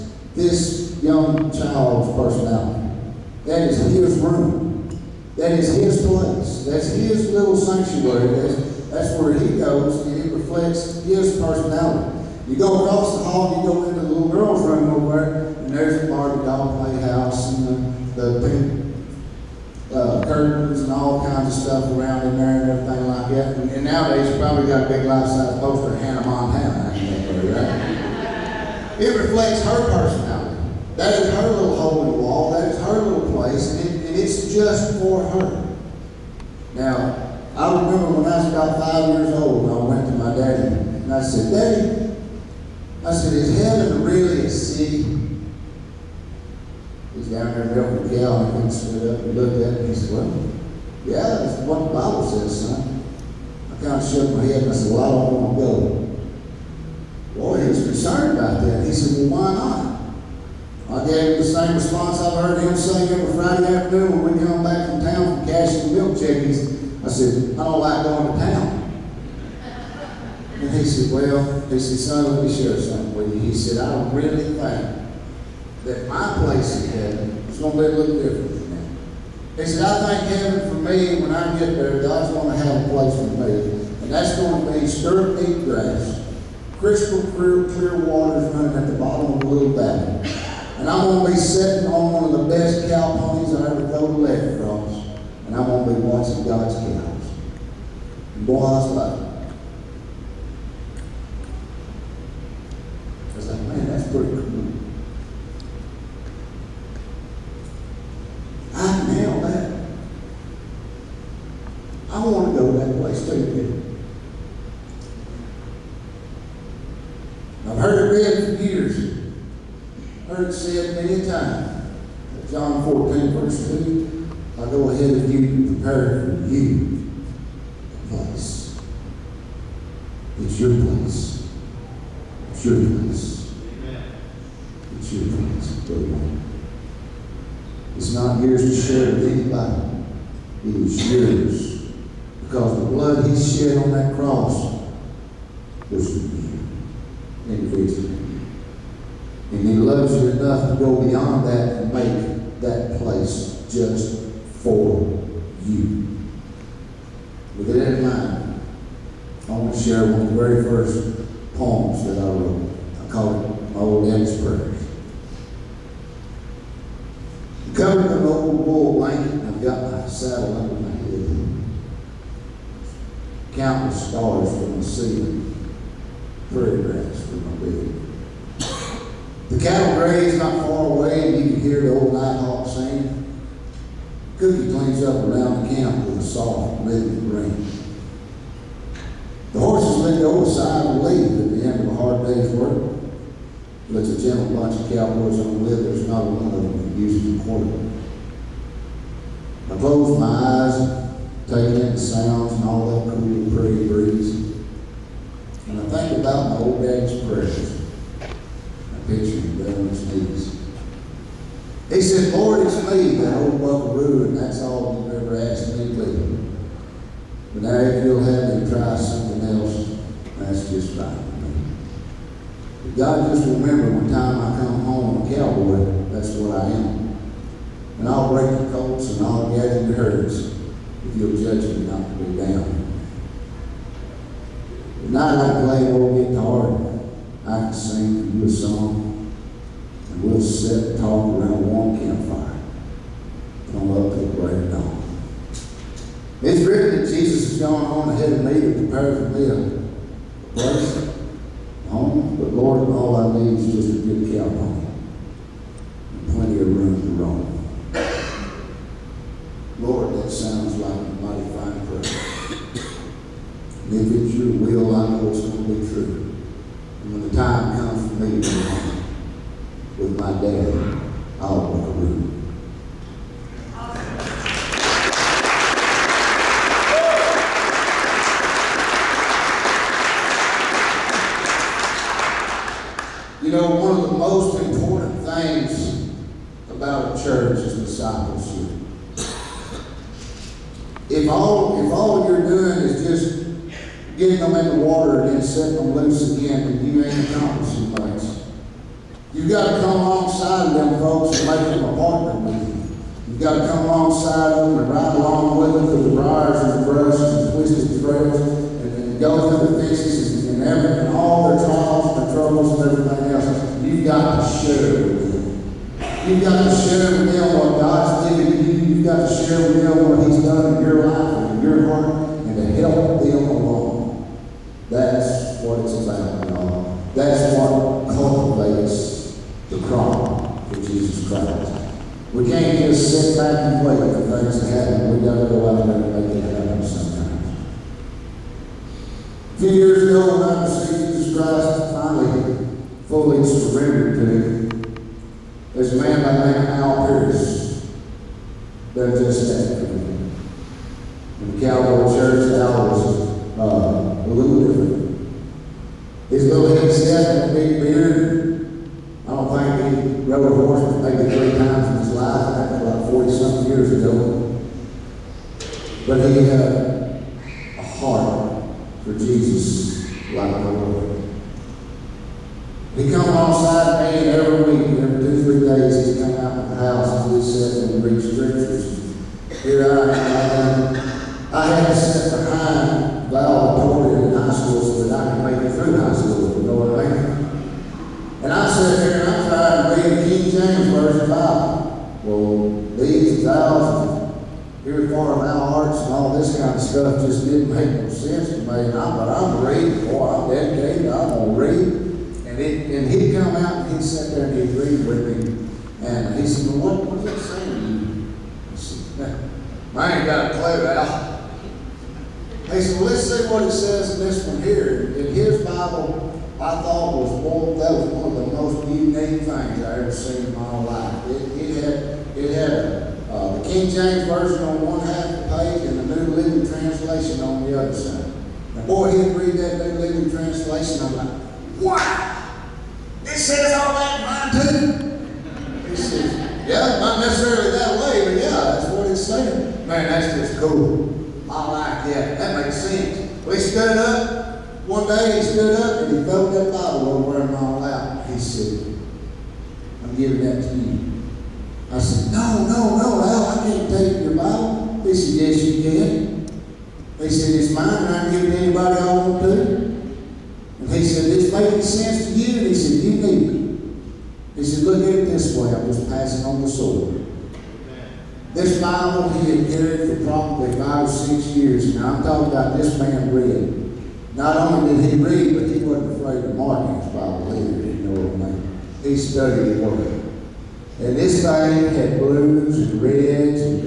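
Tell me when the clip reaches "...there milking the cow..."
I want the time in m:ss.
0:47.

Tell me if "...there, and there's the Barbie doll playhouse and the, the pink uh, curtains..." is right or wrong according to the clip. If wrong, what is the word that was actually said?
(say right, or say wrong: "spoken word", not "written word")
right.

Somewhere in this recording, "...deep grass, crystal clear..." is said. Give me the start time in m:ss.
1:25.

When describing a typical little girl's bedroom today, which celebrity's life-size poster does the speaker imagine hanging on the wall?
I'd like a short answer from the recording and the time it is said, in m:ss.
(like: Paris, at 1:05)
Hannah Montana, at 0:26.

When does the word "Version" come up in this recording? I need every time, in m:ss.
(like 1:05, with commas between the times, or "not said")
6:30, 7:04.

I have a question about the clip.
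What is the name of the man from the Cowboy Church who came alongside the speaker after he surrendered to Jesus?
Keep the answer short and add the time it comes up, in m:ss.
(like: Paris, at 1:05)
Al Pierce, at 5:46.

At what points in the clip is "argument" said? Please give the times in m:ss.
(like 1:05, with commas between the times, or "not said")
not said.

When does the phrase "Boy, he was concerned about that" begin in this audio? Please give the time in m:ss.
0:57.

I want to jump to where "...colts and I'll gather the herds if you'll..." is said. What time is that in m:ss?
3:48.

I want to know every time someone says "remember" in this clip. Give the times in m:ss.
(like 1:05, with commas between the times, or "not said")
0:37, 3:43.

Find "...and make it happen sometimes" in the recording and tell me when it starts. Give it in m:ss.
5:35.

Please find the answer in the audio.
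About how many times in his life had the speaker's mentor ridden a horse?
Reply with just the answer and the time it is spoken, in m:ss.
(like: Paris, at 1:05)
3, at 6:01.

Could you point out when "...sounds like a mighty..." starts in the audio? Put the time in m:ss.
4:20.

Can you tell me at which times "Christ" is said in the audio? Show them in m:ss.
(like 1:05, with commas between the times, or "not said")
5:31, 5:41.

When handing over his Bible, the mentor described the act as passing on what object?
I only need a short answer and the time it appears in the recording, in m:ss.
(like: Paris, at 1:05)
the sword, at 7:46.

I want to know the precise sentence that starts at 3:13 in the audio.
But it's a gentle bunch of cowboys on the lid.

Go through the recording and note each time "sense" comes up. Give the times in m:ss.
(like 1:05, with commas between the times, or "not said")
6:38, 7:22, 7:41.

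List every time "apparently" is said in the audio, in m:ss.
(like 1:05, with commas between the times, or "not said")
not said.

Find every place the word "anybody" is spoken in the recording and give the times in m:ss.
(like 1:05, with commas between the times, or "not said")
2:19, 7:38.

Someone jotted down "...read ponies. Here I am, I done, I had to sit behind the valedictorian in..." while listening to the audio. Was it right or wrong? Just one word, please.
wrong.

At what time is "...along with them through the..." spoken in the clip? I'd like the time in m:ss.
5:05.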